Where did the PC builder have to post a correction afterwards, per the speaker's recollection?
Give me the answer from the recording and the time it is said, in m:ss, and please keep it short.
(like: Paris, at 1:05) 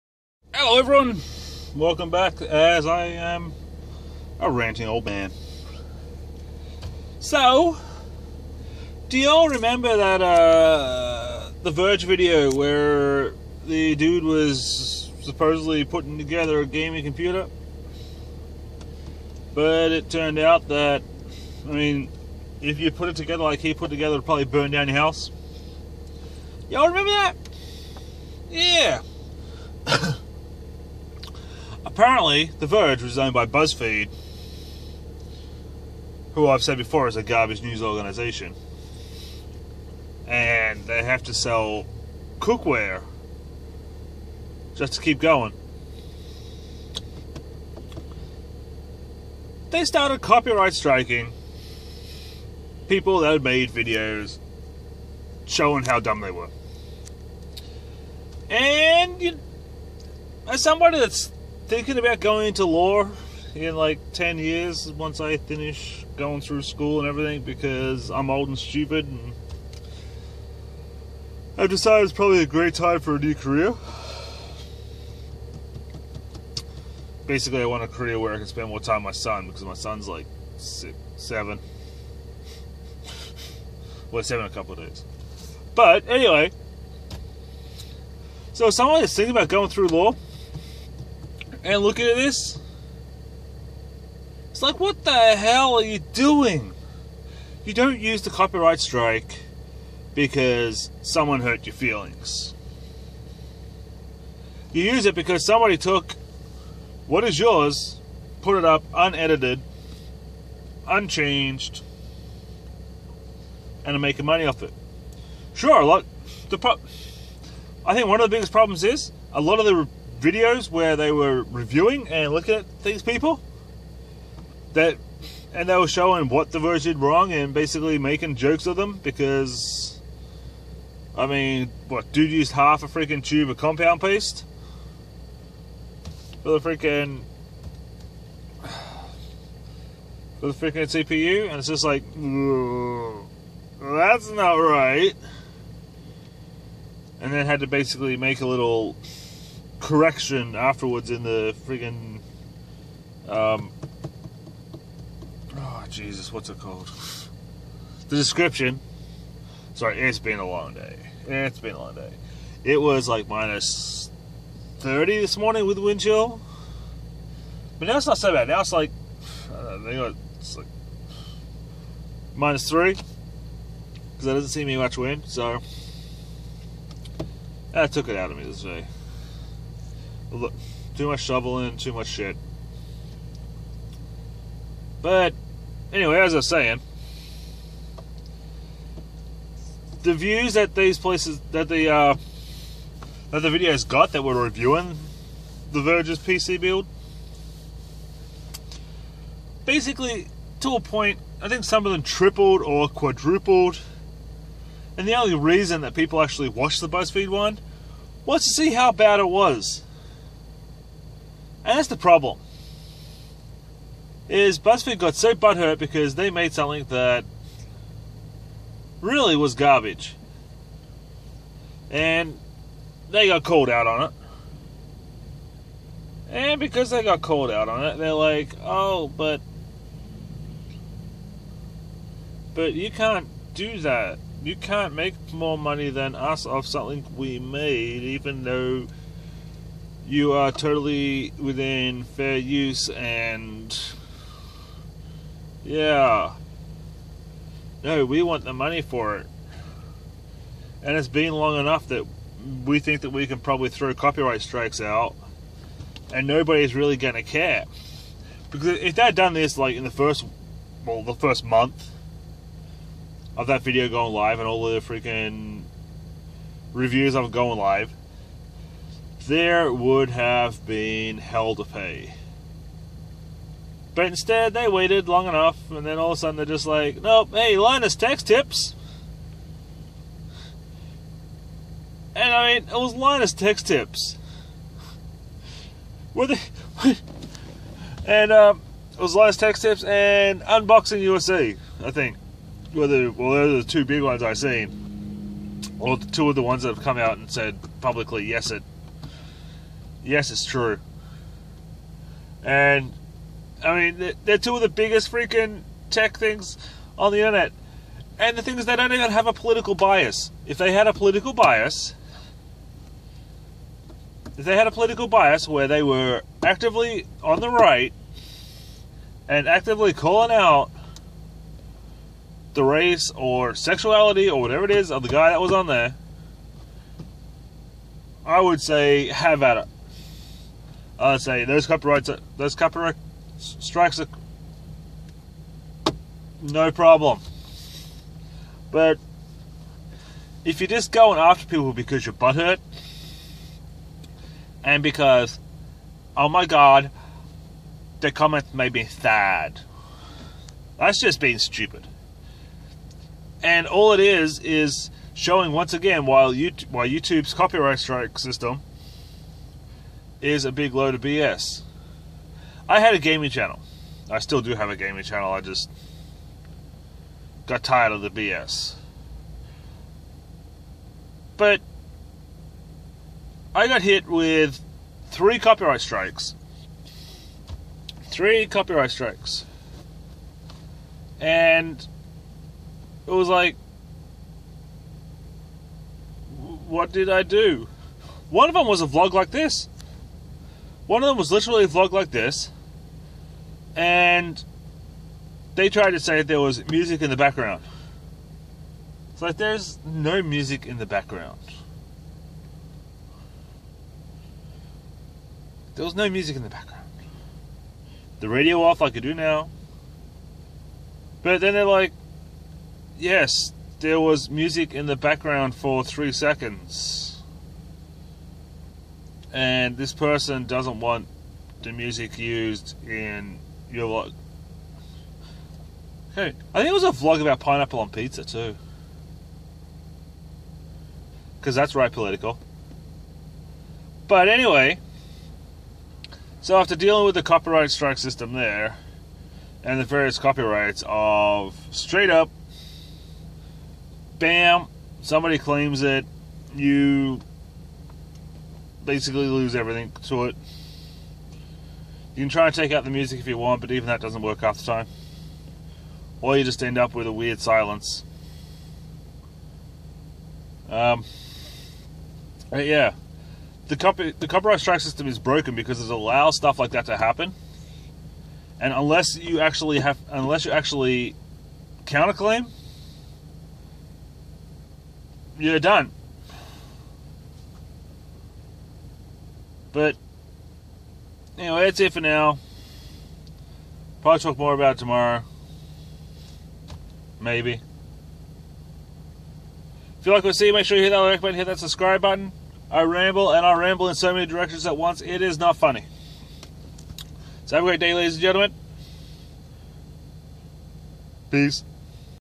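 the description, at 2:38.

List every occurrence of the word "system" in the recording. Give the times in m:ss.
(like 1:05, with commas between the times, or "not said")
5:58, 7:17, 7:44.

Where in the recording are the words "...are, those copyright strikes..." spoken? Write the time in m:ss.
5:32.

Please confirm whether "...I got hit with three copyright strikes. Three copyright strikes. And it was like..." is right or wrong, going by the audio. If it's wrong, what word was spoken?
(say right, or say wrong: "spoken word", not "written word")
right.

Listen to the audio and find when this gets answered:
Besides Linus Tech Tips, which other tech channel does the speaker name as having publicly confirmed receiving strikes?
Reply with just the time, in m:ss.
4:50.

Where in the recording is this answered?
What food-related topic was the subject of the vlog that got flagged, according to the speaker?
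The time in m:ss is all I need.
7:07.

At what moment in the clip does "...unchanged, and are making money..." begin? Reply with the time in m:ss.
1:50.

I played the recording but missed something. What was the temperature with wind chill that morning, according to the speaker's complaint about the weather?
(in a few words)
minus 30.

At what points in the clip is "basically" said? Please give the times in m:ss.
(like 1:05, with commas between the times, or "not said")
1:17, 2:07, 2:27, 3:19, 7:28.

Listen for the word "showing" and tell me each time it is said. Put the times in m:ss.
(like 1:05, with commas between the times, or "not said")
0:55, 2:05, 5:55.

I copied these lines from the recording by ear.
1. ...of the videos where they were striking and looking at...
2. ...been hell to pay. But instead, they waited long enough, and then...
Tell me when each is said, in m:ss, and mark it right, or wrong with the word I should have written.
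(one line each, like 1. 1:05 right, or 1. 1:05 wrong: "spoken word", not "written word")
1. 1:59 wrong: "reviewing", not "striking"
2. 4:30 right.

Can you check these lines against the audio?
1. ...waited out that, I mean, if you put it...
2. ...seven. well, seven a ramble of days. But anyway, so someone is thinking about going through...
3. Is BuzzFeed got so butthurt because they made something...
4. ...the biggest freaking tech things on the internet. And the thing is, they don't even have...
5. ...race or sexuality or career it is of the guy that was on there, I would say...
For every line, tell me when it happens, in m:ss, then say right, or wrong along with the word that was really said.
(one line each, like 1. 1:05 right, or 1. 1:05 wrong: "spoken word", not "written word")
1. 0:20 wrong: "turned", not "waited"
2. 1:21 wrong: "couple", not "ramble"
3. 3:34 right
4. 5:04 right
5. 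5:22 wrong: "whatever", not "career".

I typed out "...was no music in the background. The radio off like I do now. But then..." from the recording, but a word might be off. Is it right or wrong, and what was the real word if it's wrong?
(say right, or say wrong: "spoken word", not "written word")
right.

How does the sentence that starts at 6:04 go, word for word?
I still do have a gaming channel.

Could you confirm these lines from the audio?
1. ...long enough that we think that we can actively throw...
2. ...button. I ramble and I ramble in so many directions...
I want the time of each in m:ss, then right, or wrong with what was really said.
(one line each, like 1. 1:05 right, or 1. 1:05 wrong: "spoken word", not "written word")
1. 4:11 wrong: "probably", not "actively"
2. 8:12 right.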